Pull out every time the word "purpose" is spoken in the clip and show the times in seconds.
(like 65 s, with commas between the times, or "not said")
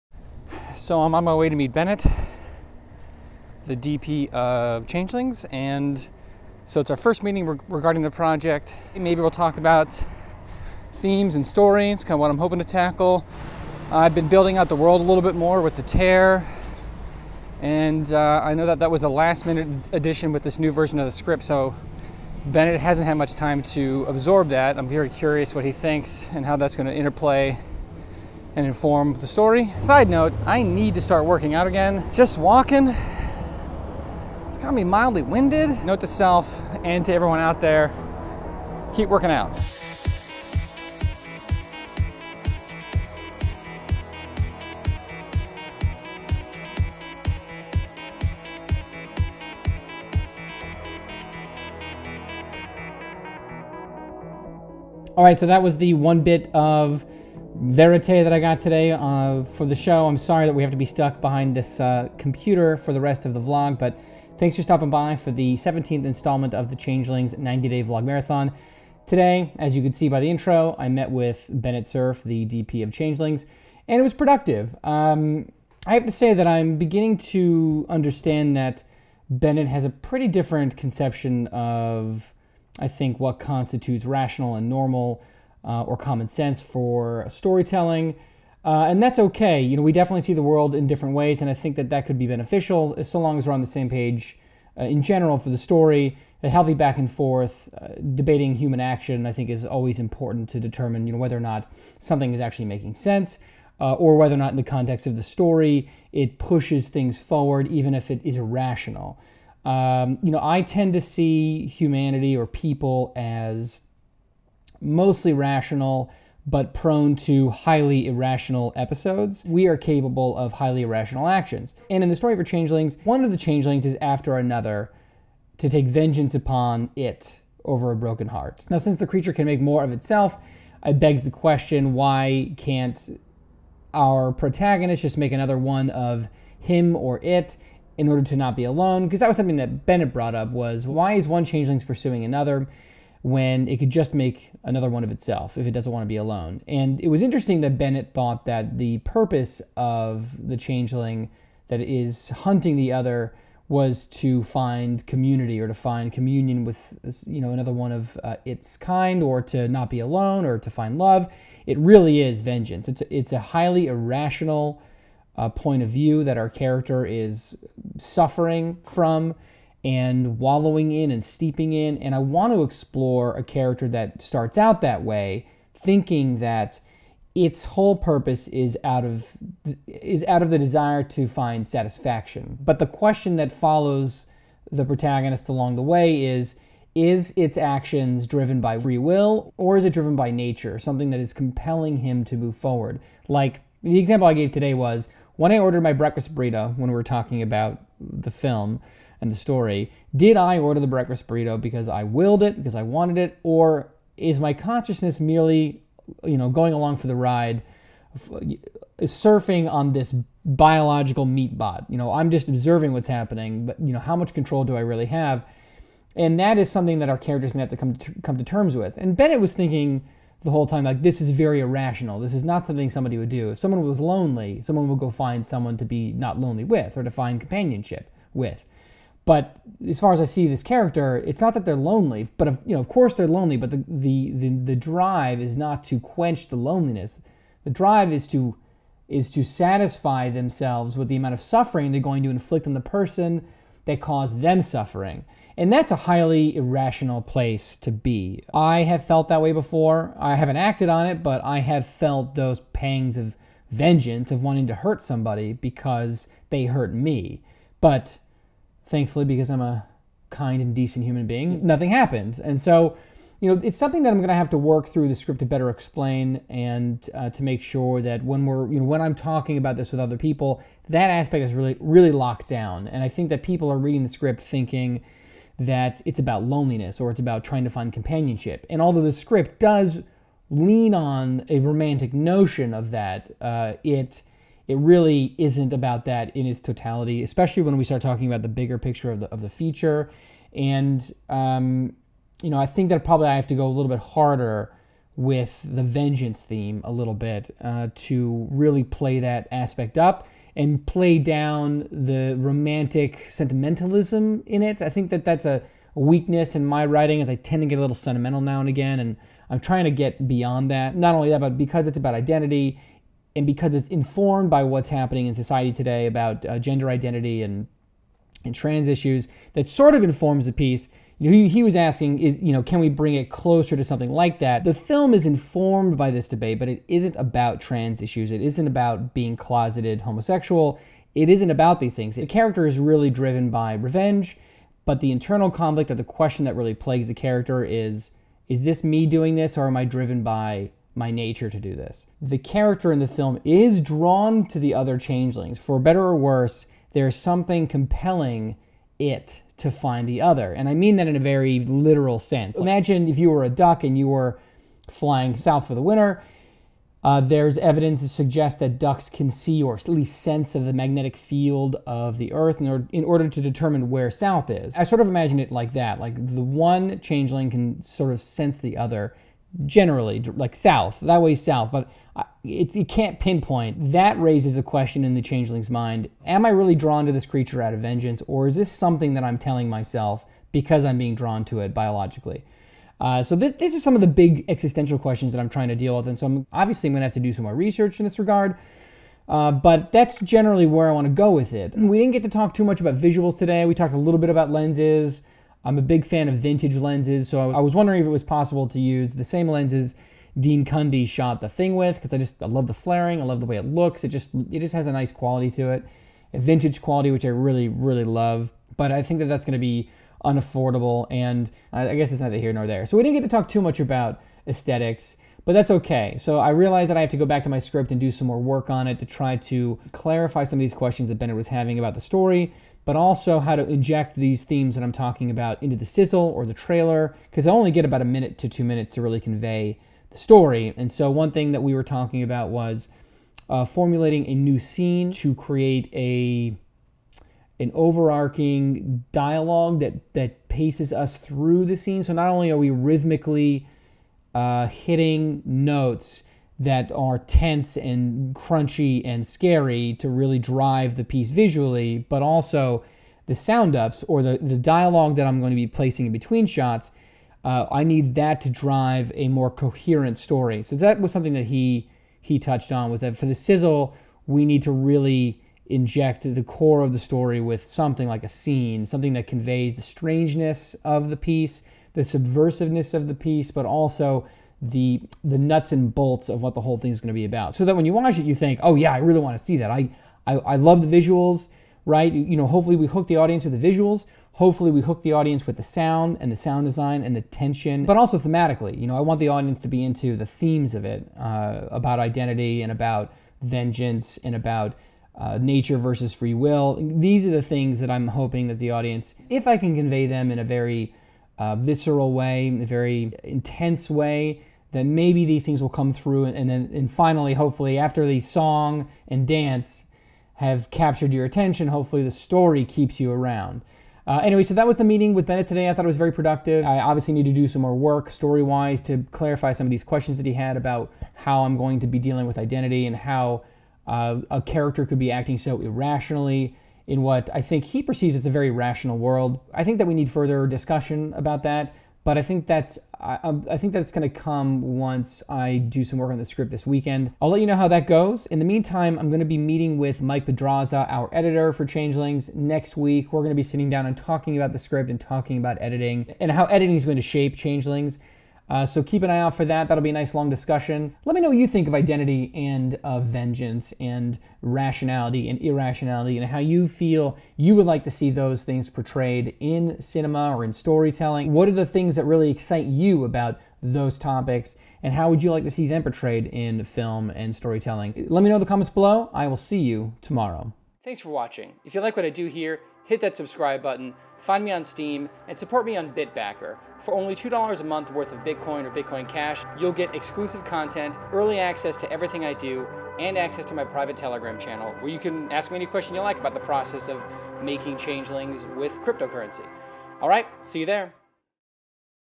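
148 s, 177 s.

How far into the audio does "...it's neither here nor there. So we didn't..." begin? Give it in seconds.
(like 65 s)
412 s.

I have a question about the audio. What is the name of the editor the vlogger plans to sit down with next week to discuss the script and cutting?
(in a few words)
Mike Pedraza.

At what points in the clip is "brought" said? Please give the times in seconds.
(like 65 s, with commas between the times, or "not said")
140 s.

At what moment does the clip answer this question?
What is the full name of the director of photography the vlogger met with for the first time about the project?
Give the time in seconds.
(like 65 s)
71 s.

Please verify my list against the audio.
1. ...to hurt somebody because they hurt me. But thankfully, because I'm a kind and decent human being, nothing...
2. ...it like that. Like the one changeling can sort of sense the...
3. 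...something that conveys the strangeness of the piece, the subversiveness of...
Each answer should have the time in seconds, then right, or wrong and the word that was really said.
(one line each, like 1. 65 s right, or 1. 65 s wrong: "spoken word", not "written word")
1. 254 s right
2. 365 s right
3. 468 s right.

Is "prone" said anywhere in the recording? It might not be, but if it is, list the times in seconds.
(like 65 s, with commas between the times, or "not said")
116 s.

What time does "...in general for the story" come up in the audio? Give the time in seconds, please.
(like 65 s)
94 s.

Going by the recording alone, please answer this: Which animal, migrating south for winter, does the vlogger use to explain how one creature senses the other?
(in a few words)
Duck.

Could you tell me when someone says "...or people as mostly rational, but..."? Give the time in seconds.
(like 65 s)
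112 s.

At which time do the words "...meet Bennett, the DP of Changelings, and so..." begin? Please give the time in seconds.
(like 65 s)
1 s.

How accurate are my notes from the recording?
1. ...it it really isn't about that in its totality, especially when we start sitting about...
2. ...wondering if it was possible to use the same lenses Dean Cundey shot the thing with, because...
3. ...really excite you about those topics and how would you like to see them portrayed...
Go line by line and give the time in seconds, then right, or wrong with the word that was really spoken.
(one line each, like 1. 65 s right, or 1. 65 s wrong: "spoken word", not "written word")
1. 283 s wrong: "talking", not "sitting"
2. 397 s right
3. 562 s right.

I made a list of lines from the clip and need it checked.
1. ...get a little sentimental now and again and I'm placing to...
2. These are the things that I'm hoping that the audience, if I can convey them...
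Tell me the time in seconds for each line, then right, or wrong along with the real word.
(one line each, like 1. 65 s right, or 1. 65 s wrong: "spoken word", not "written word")
1. 307 s wrong: "trying", not "placing"
2. 496 s right.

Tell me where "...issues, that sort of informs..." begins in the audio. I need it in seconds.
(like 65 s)
318 s.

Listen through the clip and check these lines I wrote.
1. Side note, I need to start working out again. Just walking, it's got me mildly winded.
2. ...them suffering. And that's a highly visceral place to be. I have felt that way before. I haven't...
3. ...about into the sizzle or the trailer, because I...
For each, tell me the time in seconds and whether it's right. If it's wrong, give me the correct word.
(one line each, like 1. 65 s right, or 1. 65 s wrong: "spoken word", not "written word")
1. 29 s right
2. 244 s wrong: "irrational", not "visceral"
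3. 425 s right.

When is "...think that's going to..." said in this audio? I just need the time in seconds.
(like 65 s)
533 s.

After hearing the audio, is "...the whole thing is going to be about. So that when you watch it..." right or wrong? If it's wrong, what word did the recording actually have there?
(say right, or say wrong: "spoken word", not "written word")
right.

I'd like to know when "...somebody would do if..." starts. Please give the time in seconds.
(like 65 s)
222 s.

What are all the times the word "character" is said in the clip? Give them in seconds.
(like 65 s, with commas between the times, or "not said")
166 s, 173 s, 217 s, 230 s, 332 s, 337 s, 342 s, 524 s.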